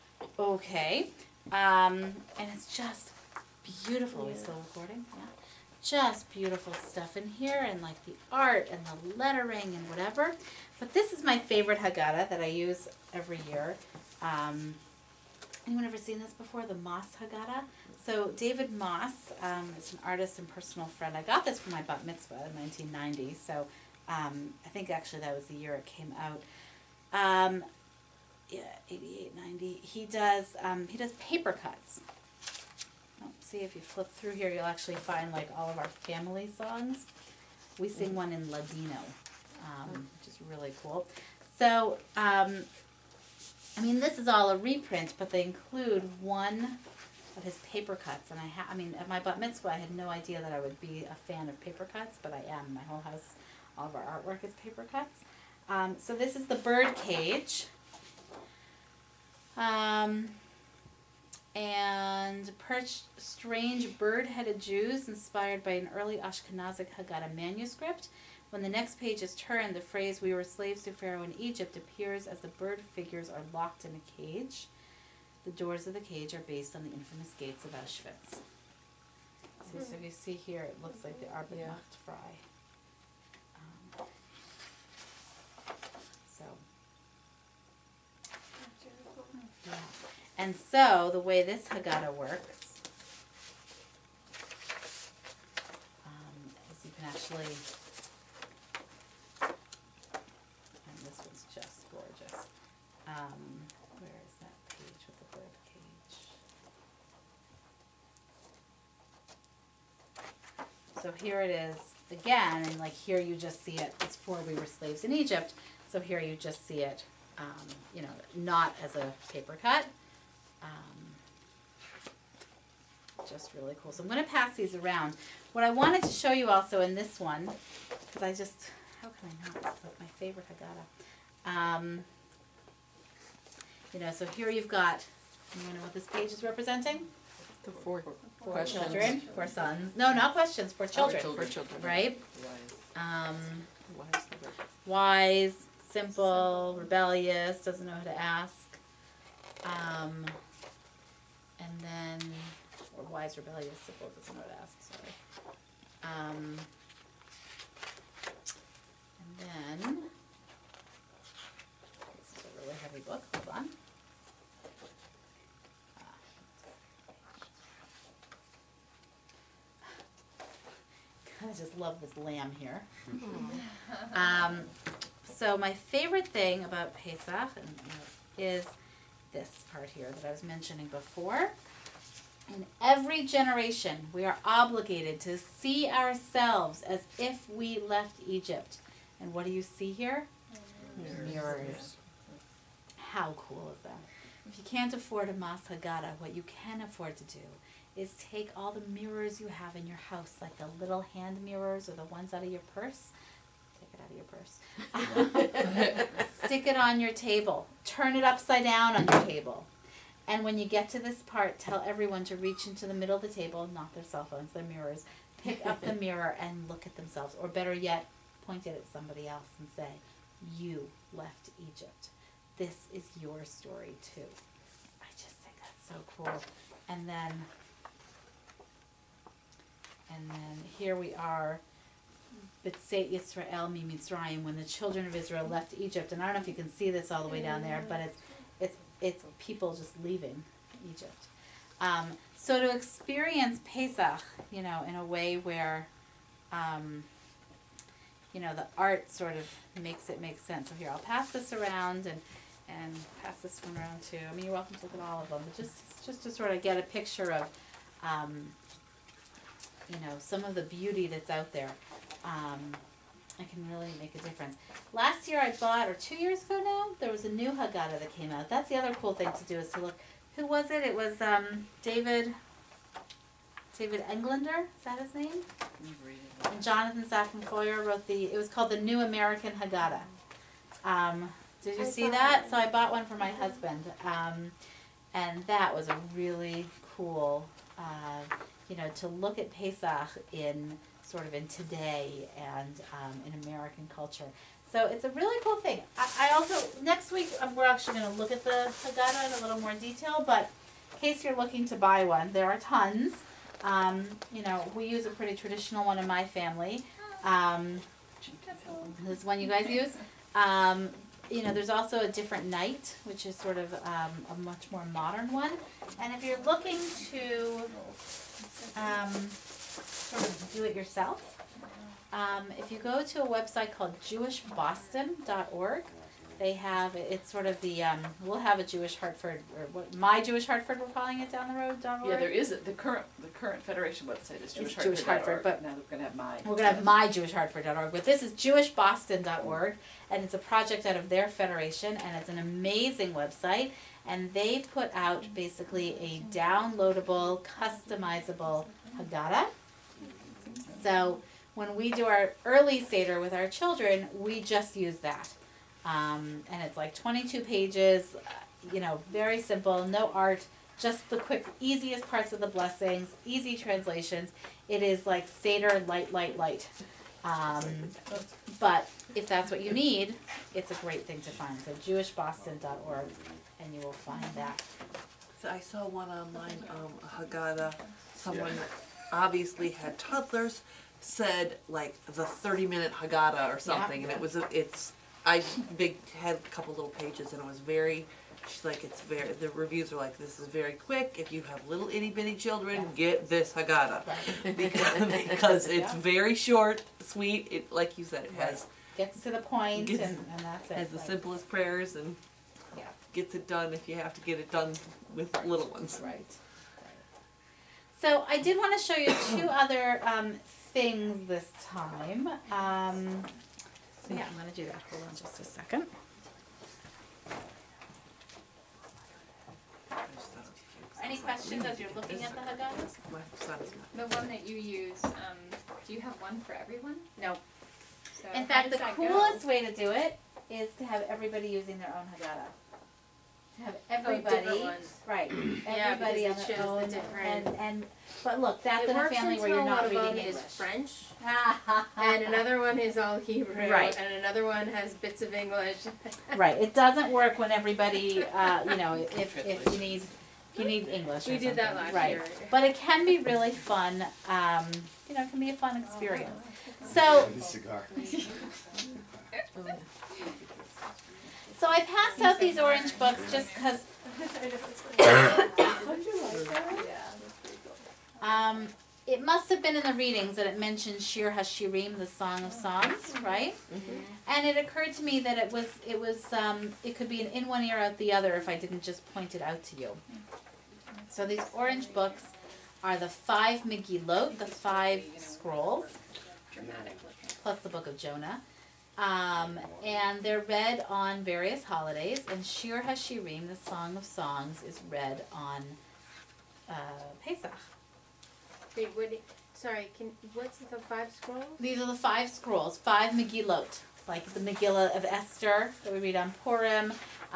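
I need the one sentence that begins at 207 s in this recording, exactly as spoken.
Turn it upside down on your table.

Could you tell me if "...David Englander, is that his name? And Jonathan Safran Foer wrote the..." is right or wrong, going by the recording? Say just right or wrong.
right.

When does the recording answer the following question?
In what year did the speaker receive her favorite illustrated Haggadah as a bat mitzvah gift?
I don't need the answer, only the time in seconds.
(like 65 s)
22 s.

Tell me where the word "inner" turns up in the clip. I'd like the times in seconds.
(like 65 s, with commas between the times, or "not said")
not said.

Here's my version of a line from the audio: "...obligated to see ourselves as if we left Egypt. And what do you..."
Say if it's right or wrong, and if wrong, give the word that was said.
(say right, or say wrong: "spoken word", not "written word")
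right.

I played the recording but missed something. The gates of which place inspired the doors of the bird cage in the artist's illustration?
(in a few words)
Auschwitz.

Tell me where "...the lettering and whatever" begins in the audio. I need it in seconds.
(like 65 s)
8 s.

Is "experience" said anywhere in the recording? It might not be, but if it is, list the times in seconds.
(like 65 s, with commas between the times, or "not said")
242 s, 455 s.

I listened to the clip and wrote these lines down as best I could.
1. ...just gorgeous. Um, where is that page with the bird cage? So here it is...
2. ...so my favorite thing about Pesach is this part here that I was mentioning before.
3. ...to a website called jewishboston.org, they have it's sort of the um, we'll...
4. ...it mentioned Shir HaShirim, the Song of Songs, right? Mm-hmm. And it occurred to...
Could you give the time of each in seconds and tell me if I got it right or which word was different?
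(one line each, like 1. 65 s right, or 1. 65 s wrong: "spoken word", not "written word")
1. 101 s right
2. 175 s right
3. 323 s right
4. 470 s right.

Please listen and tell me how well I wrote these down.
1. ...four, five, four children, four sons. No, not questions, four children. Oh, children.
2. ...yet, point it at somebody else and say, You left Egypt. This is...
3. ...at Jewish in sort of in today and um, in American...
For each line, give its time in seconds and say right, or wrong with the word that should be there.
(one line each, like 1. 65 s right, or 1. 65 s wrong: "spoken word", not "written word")
1. 137 s wrong: "four", not "five"
2. 217 s right
3. 289 s wrong: "Pesach", not "Jewish".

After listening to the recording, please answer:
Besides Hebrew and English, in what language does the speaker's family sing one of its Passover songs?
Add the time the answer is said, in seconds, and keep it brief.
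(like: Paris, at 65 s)
Ladino, at 38 s.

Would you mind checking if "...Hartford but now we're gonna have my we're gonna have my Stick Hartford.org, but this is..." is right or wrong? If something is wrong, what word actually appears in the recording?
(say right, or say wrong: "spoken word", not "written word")
wrong: "Jewish", not "Stick".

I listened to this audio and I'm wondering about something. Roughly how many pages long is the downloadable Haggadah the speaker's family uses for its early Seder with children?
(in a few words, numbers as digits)
22.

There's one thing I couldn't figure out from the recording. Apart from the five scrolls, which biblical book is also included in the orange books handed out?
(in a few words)
Jonah.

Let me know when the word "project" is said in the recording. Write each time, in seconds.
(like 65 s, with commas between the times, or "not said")
340 s.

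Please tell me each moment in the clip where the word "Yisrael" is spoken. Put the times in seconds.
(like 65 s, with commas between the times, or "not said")
233 s.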